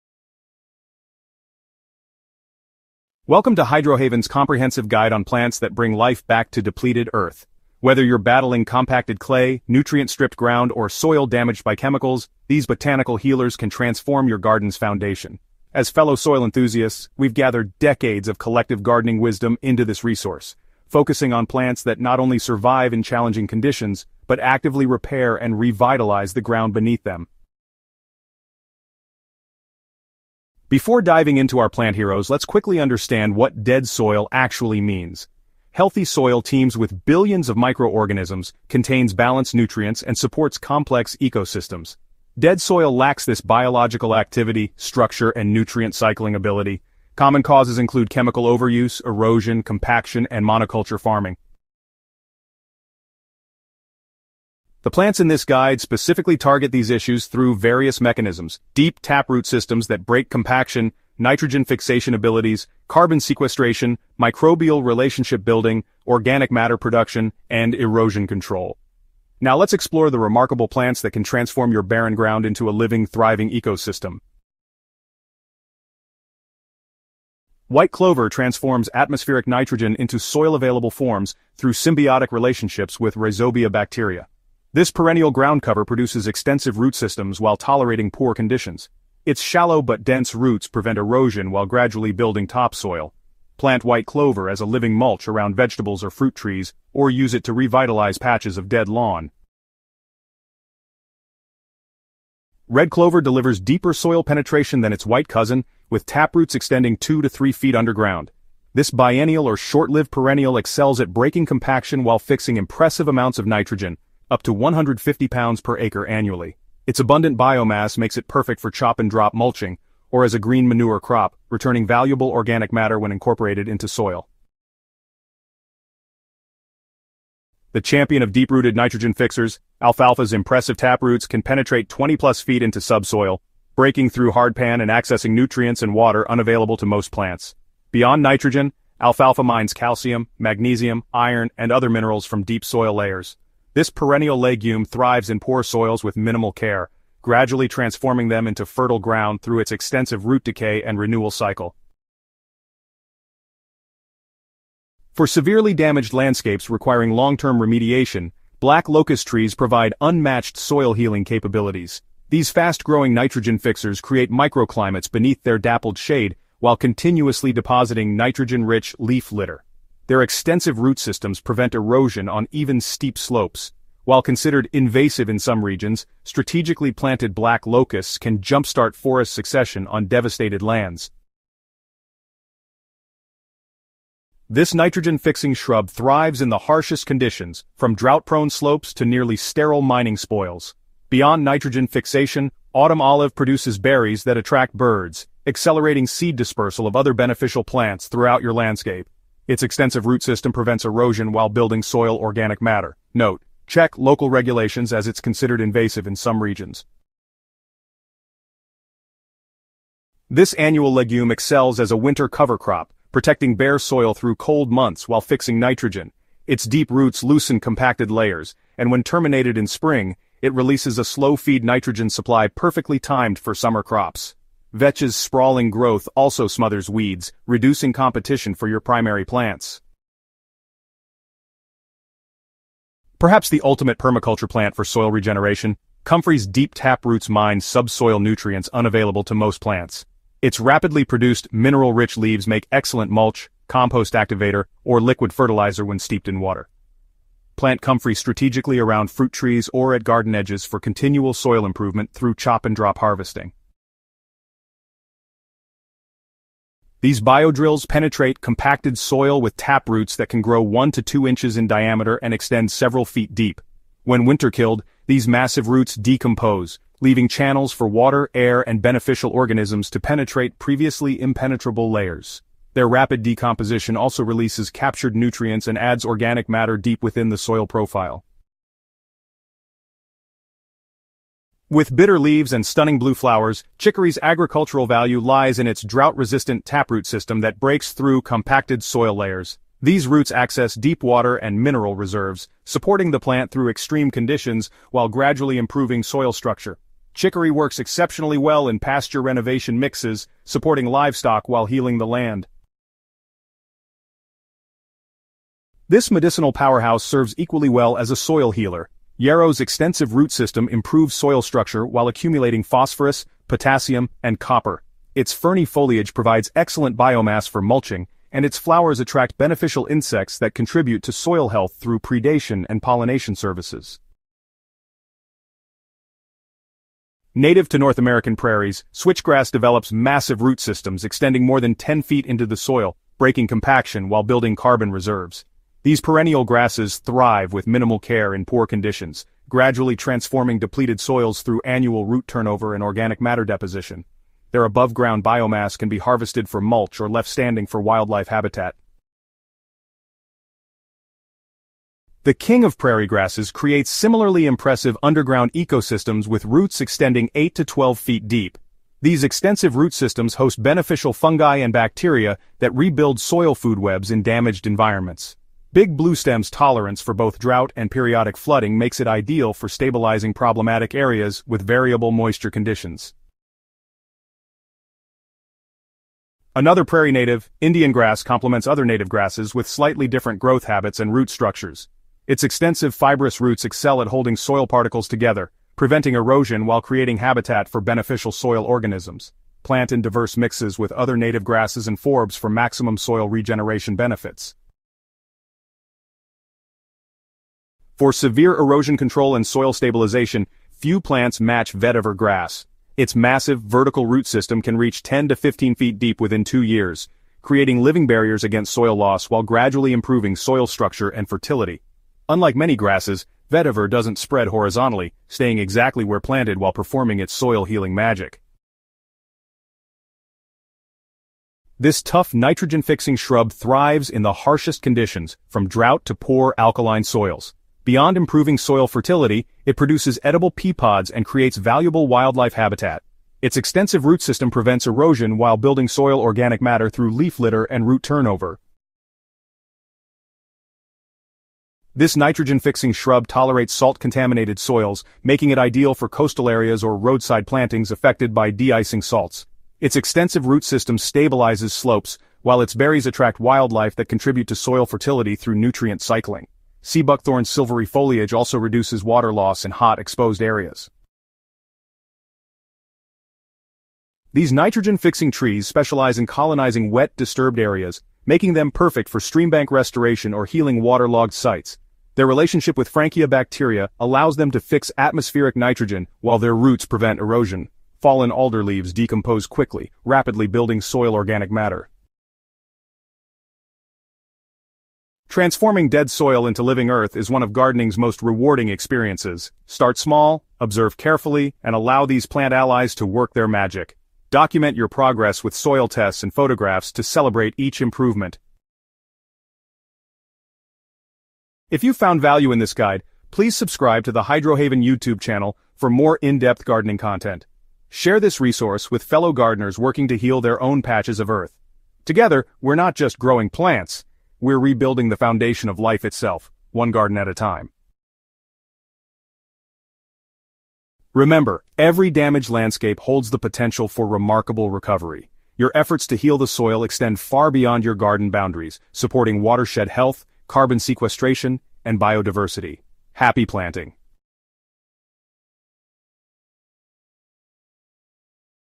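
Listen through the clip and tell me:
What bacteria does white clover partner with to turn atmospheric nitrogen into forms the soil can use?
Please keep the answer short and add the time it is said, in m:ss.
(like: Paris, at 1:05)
rhizobia, at 1:23.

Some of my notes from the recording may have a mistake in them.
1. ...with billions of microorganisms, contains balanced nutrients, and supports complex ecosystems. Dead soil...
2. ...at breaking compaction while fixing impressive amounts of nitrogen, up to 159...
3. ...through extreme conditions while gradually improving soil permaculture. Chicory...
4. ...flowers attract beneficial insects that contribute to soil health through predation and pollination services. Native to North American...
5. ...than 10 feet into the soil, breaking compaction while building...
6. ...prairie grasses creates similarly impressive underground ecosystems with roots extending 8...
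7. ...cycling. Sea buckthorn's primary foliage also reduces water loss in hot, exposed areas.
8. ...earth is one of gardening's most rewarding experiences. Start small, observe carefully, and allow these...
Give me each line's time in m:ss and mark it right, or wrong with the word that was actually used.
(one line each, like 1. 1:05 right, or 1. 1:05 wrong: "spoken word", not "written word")
1. 0:36 right
2. 1:51 wrong: "150", not "159"
3. 4:53 wrong: "structure", not "permaculture"
4. 5:18 right
5. 5:31 right
6. 5:52 right
7. 7:36 wrong: "silvery", not "primary"
8. 8:06 right.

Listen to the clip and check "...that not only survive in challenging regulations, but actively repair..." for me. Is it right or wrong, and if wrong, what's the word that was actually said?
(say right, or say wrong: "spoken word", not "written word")
wrong: "conditions", not "regulations".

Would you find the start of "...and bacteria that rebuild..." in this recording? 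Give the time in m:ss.
6:01.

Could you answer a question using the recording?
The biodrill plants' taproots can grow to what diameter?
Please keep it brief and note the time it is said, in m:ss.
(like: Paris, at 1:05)
1 to 2 inches, at 4:20.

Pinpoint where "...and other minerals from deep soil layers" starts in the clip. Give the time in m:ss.
2:21.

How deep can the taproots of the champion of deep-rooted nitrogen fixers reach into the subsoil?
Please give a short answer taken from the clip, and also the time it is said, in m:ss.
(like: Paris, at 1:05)
20-plus feet, at 2:11.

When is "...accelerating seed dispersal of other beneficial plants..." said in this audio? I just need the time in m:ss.
3:15.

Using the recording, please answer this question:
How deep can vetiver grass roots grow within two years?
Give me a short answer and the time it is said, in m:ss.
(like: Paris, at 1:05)
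10 to 15 feet, at 6:45.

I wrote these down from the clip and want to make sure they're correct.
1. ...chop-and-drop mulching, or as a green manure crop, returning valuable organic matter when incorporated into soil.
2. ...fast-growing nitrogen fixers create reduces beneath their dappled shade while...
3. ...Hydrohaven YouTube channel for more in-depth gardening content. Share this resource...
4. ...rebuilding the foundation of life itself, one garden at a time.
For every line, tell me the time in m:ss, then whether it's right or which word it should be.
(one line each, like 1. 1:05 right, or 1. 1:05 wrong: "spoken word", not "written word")
1. 1:58 right
2. 2:42 wrong: "microclimates", not "reduces"
3. 8:24 right
4. 8:34 right.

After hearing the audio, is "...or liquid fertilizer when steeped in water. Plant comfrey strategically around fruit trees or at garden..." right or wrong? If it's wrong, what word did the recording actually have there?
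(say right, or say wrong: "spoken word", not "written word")
right.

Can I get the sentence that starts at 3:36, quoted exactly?
Its deep roots loosen compacted layers, and when terminated in spring, it releases a slow-feed nitrogen supply perfectly timed for summer crops.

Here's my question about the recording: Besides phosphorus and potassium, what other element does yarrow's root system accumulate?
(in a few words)
copper.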